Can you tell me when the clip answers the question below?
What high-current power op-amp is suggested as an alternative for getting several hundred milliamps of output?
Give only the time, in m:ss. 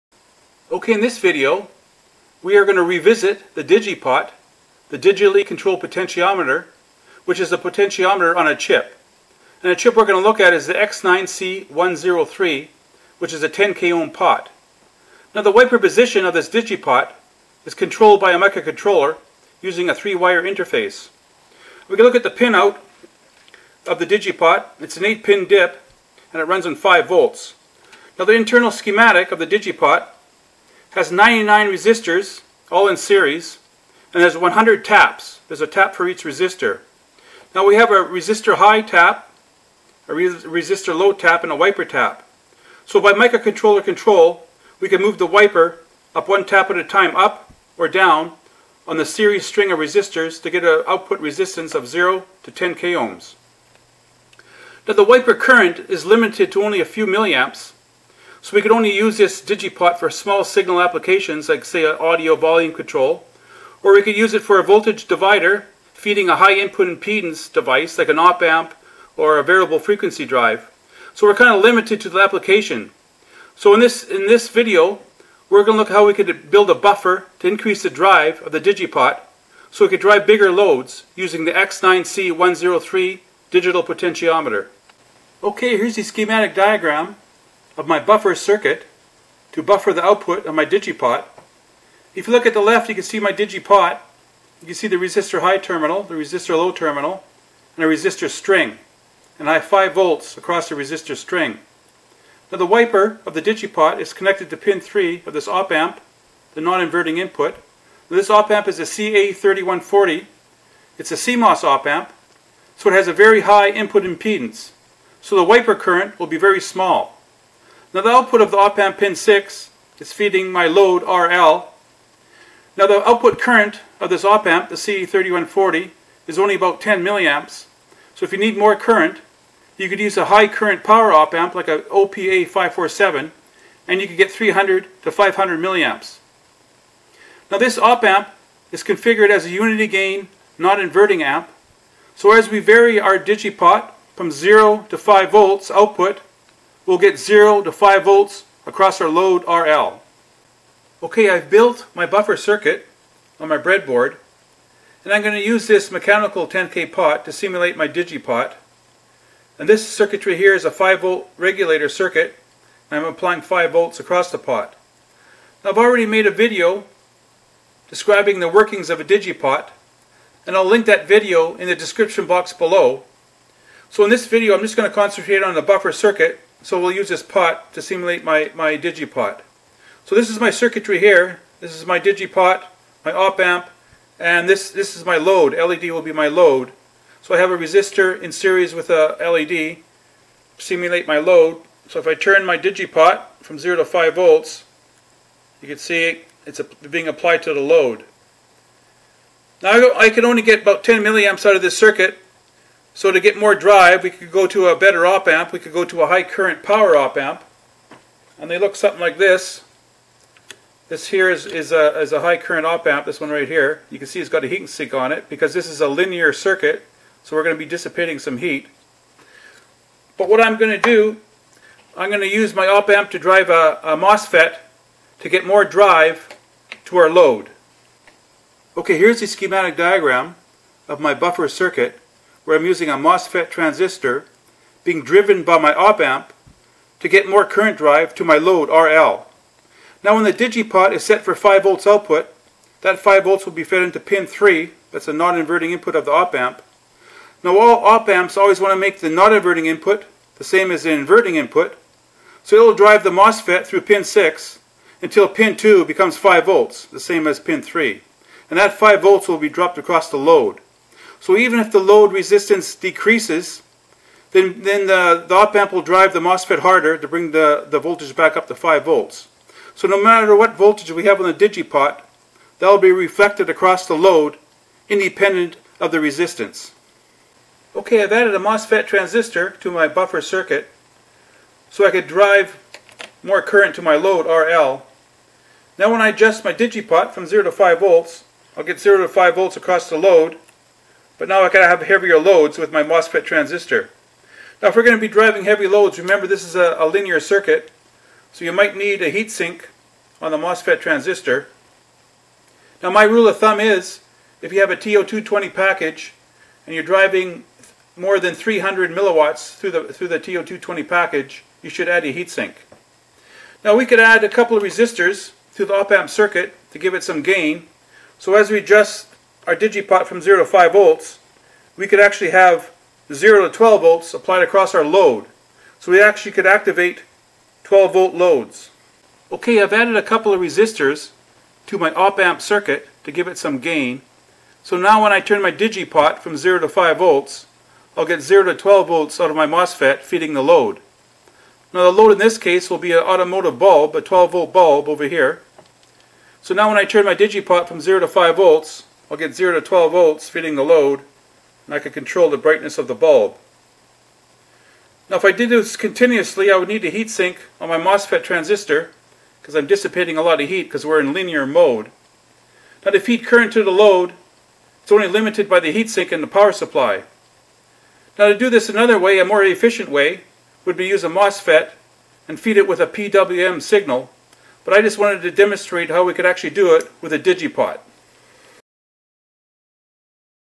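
2:11.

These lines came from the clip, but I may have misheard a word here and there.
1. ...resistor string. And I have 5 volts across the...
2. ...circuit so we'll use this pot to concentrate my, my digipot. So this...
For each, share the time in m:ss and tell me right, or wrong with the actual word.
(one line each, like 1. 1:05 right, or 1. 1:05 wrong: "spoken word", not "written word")
1. 1:37 right
2. 2:55 wrong: "simulate", not "concentrate".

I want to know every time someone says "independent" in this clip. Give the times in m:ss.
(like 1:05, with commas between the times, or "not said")
4:34.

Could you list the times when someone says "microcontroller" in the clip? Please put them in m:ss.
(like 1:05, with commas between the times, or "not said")
0:18, 0:43.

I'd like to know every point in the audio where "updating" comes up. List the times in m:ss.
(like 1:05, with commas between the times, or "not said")
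not said.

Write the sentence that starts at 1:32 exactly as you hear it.
If you look at the left, you can see my digipot.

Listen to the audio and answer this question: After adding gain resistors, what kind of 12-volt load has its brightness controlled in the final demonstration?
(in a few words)
Automotive bulb.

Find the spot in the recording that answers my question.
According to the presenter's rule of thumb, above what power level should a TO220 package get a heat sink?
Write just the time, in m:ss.
5:08.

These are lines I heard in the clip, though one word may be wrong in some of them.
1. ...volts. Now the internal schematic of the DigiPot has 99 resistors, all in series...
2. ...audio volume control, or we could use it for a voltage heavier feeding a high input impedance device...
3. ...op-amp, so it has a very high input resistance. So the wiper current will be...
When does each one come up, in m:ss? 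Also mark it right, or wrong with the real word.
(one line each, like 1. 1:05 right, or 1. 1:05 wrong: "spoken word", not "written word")
1. 0:27 right
2. 1:01 wrong: "divider", not "heavier"
3. 1:51 wrong: "impedance", not "resistance".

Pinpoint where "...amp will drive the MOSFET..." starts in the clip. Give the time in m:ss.
4:25.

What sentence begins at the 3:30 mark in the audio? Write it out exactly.
This here is, is, a, is a high current op-amp, this one right here.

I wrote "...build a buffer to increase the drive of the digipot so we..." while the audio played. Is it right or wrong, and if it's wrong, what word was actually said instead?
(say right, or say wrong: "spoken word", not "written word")
right.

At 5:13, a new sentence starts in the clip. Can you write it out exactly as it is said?
Now we could add a couple of resistors to the op-amp circuit to give it some gain.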